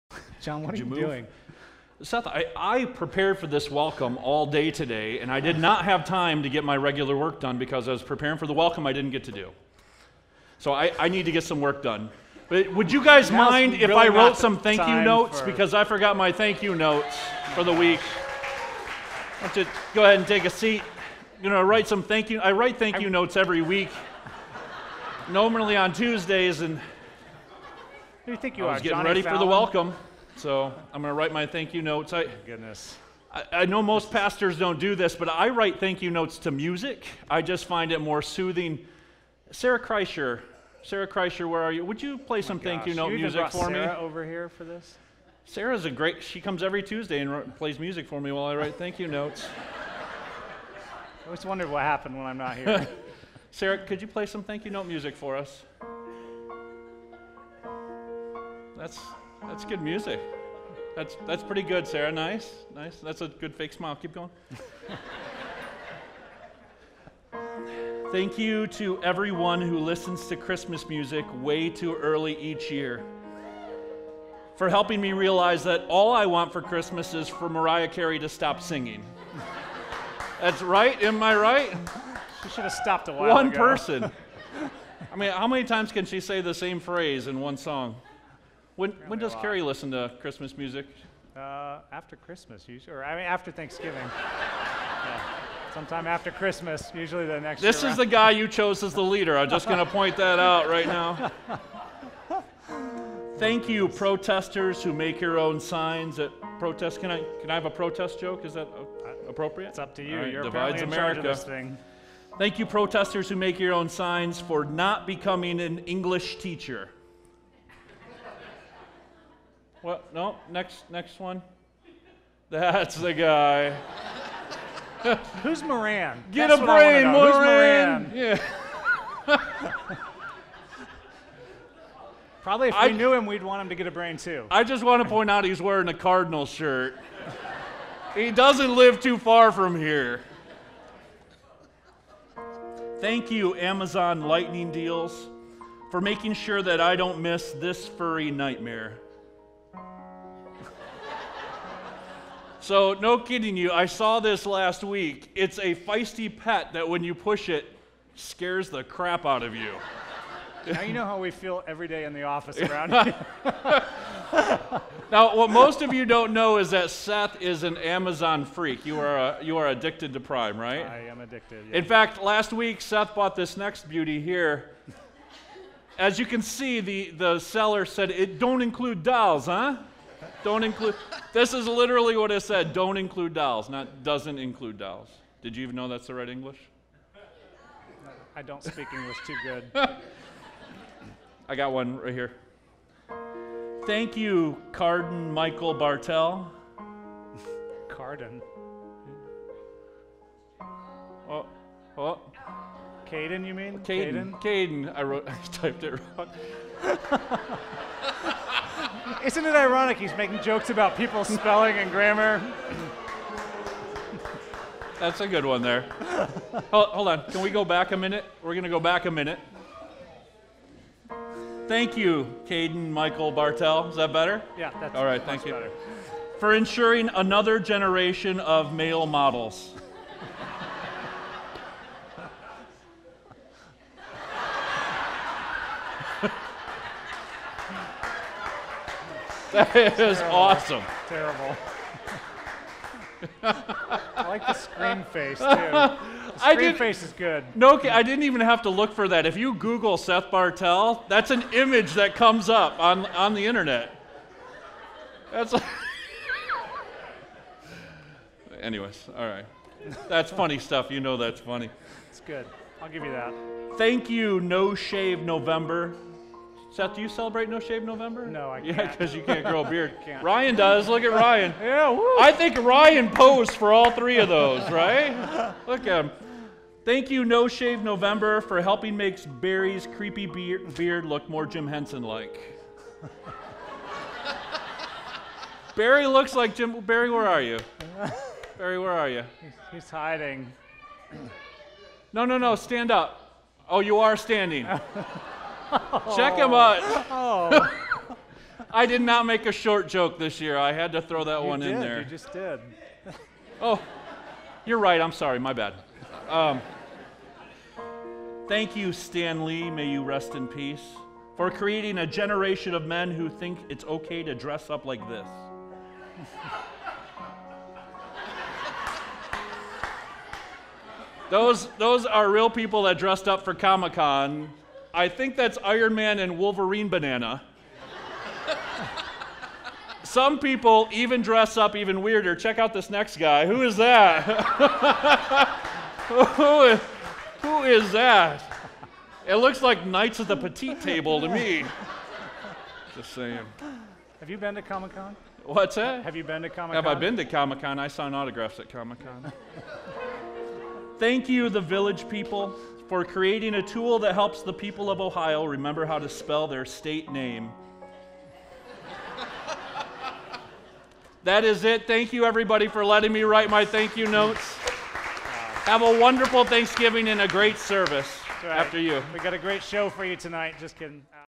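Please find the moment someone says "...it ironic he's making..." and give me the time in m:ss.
3:29.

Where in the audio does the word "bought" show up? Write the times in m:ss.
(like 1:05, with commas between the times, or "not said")
2:53.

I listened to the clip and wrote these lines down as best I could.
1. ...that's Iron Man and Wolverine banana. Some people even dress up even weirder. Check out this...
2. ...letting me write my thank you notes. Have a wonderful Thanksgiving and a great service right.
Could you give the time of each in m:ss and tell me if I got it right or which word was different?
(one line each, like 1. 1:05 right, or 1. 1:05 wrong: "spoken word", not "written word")
1. 5:25 right
2. 6:02 right.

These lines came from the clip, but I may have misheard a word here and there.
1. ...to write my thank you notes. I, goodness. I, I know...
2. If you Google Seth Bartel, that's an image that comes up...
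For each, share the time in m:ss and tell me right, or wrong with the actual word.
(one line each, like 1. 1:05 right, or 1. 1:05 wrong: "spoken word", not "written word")
1. 0:31 right
2. 4:09 right.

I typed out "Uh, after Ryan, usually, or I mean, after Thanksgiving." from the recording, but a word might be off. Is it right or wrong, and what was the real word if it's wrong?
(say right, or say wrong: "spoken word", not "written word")
wrong: "Christmas", not "Ryan".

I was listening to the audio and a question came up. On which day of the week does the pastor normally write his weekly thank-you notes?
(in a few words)
Tuesdays.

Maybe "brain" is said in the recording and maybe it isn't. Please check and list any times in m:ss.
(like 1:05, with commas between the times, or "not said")
2:06, 2:13.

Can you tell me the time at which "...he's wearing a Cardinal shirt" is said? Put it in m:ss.
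2:15.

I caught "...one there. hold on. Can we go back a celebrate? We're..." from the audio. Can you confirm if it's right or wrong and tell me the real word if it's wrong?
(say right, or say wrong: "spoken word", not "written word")
wrong: "minute", not "celebrate".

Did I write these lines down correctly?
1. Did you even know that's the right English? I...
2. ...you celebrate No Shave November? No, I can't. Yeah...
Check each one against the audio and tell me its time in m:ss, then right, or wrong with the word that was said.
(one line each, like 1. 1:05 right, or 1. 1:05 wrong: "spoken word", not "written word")
1. 3:05 right
2. 4:27 right.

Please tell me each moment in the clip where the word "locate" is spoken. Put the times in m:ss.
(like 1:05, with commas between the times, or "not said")
not said.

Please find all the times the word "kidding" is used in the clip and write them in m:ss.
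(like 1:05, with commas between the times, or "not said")
2:33, 6:10.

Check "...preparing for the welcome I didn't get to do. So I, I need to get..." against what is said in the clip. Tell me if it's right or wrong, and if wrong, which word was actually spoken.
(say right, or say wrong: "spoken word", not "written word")
right.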